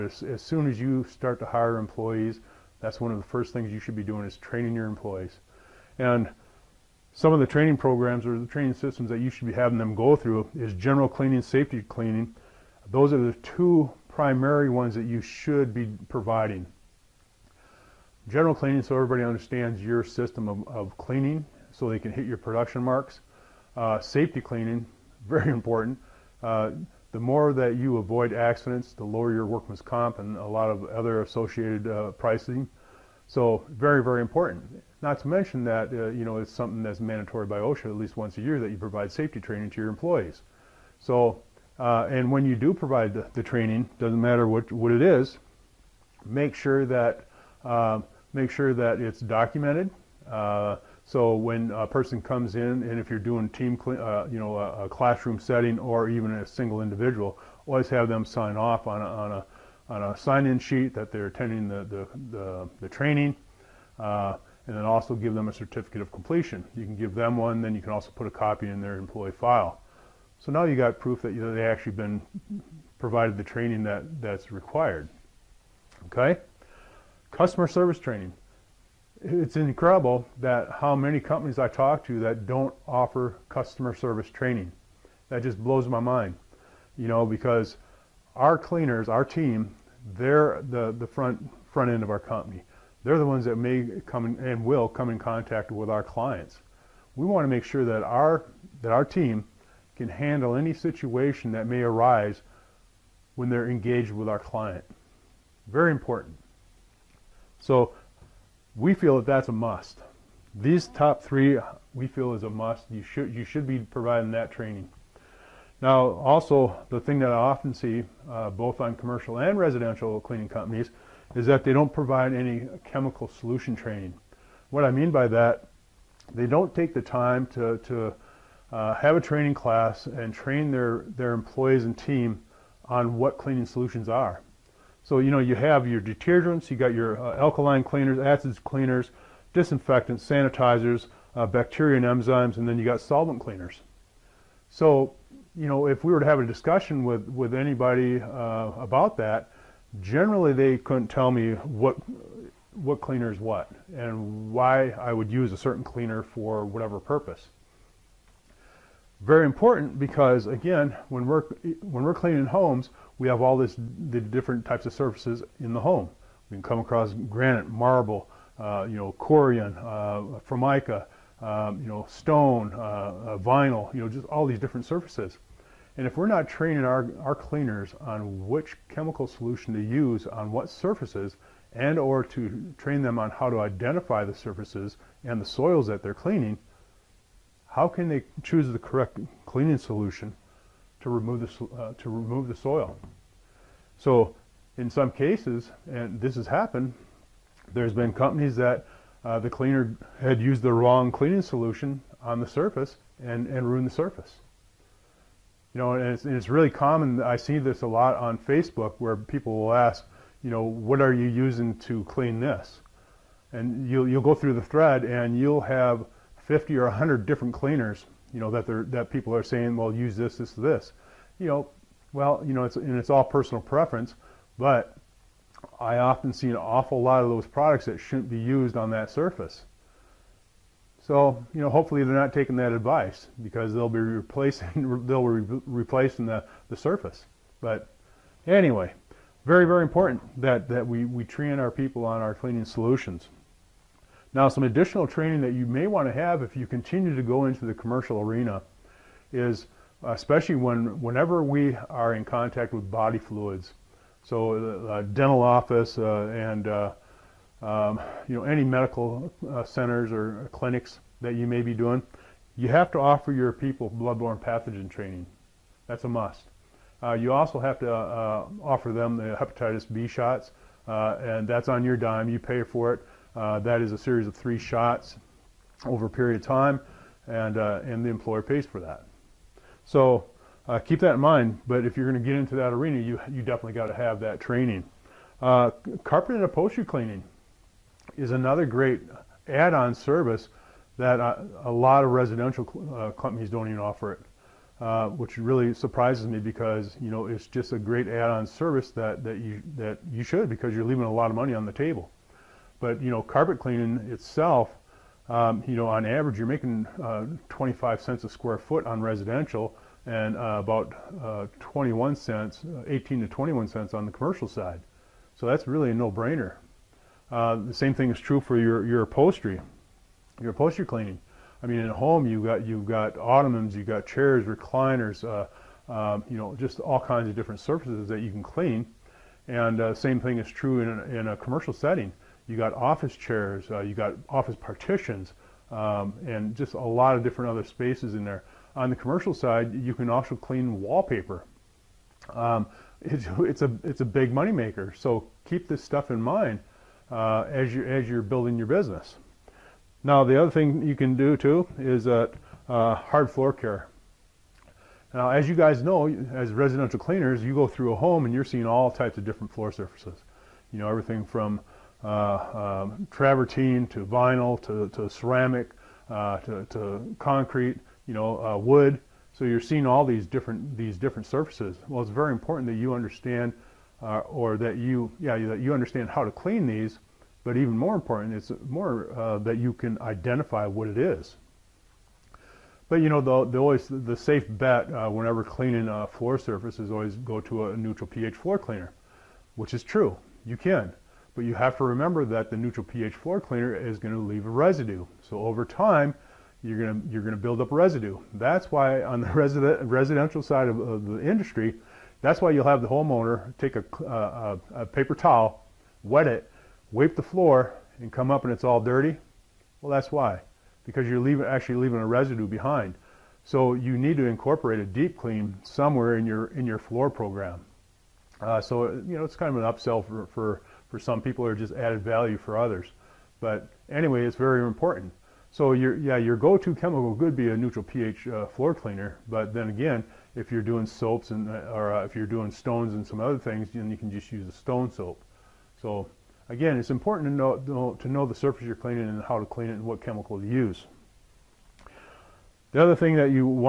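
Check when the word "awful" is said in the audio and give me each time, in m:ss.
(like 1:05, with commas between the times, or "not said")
3:46.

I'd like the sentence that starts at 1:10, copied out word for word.
So now you got proof that you know, they actually been provided the training that, that's required.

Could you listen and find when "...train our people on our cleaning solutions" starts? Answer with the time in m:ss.
4:01.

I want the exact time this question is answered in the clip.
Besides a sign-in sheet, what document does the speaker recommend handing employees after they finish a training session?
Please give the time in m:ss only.
1:05.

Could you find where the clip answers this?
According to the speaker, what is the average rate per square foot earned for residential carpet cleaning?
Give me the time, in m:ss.
5:07.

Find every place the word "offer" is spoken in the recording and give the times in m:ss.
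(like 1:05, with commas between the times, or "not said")
1:22, 4:22, 4:27, 4:53.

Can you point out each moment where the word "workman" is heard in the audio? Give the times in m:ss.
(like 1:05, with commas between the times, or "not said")
0:29.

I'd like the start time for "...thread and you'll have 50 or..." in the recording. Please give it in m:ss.
3:34.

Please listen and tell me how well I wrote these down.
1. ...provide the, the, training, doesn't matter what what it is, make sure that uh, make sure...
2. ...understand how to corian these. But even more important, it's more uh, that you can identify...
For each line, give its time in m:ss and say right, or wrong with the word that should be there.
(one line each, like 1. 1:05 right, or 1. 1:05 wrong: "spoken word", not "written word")
1. 0:42 right
2. 6:15 wrong: "clean", not "corian".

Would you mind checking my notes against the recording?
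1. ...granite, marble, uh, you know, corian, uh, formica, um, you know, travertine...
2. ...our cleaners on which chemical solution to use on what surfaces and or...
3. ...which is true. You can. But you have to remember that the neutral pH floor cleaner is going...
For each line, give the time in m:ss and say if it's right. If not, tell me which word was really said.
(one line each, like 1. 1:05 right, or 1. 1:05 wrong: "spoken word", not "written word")
1. 2:47 wrong: "stone", not "travertine"
2. 2:57 right
3. 6:29 right.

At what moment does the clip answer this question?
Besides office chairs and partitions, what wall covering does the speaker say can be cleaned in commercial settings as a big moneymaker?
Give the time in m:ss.
5:40.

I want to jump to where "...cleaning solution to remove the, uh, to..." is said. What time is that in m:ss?
3:09.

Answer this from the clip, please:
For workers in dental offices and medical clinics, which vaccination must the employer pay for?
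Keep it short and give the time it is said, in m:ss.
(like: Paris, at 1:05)
hepatitis B shots, at 4:29.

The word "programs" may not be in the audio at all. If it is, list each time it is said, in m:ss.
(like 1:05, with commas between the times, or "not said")
0:07, 6:57.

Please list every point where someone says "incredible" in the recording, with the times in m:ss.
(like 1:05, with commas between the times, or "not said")
1:19.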